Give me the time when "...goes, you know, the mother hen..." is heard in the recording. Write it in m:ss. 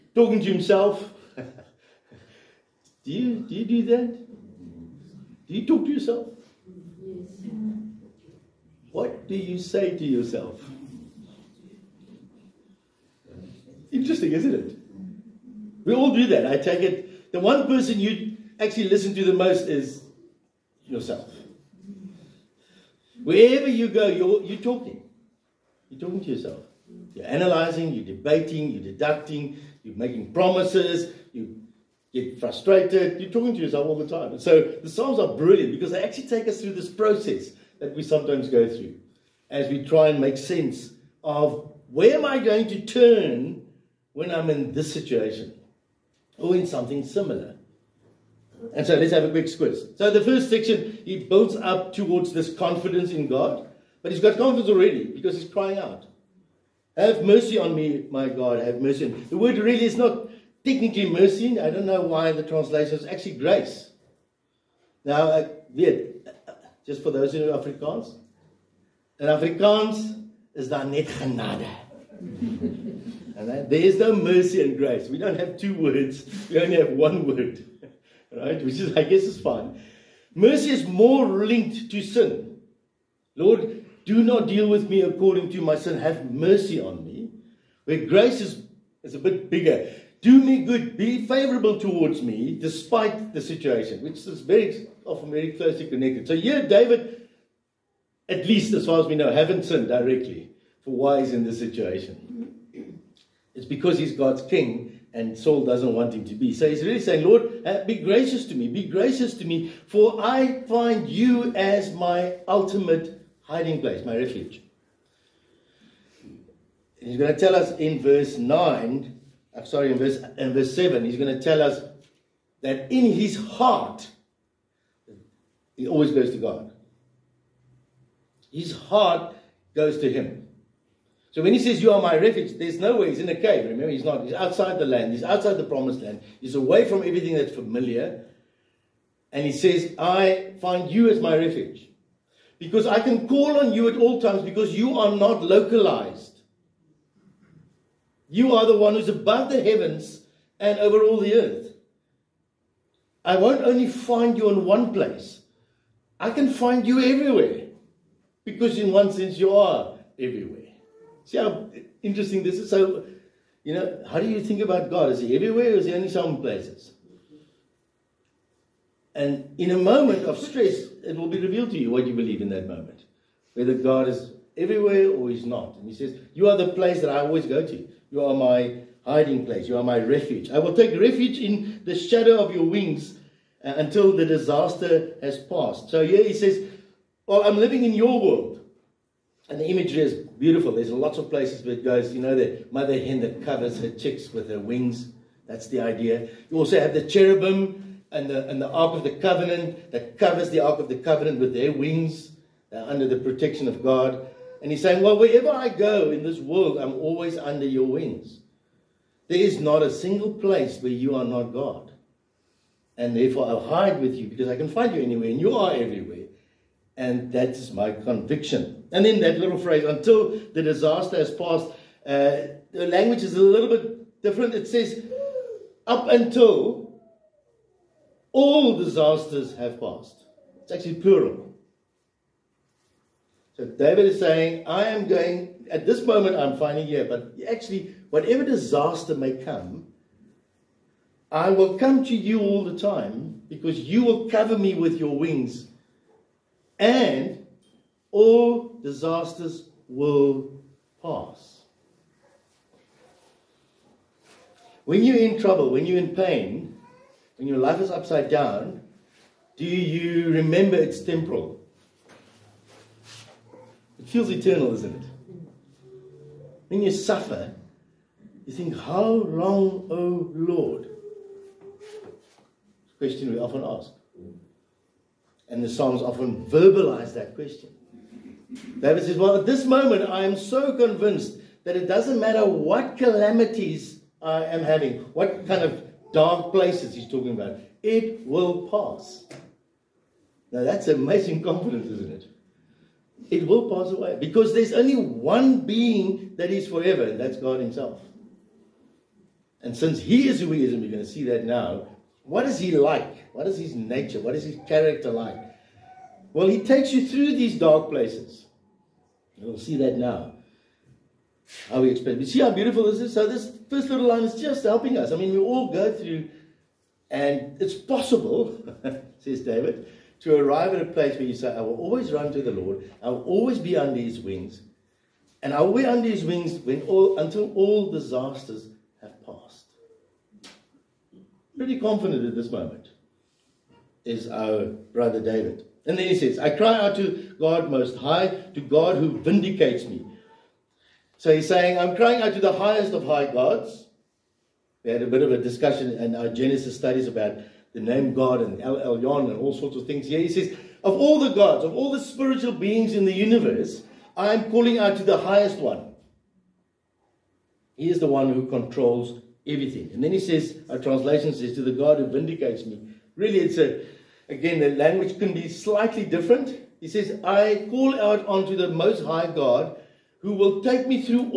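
3:11.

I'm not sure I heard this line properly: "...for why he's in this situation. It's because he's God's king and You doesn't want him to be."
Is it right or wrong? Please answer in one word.
wrong.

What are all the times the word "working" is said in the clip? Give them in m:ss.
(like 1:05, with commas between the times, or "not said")
not said.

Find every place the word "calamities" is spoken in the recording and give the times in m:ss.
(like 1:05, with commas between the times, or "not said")
4:42.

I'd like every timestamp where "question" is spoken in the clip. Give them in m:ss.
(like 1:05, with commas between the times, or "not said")
4:32, 4:37.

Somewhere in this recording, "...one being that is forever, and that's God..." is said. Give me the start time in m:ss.
4:54.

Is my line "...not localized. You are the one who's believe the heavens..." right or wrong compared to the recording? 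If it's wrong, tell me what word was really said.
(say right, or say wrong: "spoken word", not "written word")
wrong: "above", not "believe".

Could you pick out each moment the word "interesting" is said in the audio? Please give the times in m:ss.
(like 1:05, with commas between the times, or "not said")
0:13, 2:42.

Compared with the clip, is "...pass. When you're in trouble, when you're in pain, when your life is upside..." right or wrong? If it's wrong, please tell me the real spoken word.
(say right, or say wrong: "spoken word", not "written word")
right.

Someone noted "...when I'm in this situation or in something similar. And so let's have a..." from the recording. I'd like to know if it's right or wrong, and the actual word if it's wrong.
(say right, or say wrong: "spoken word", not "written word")
right.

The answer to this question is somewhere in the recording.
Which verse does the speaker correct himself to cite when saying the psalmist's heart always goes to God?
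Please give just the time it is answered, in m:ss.
2:00.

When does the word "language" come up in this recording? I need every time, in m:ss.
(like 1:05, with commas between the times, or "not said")
3:42, 6:04.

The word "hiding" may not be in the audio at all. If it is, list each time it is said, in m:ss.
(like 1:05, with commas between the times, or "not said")
1:53, 2:59.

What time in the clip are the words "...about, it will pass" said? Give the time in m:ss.
4:47.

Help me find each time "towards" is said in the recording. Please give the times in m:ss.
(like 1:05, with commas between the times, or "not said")
0:51, 1:31.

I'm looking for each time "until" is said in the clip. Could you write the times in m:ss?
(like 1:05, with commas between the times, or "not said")
3:03, 3:39, 3:46, 5:27.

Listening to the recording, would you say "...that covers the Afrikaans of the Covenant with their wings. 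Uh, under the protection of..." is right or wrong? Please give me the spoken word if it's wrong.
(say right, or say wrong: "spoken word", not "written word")
wrong: "Ark", not "Afrikaans".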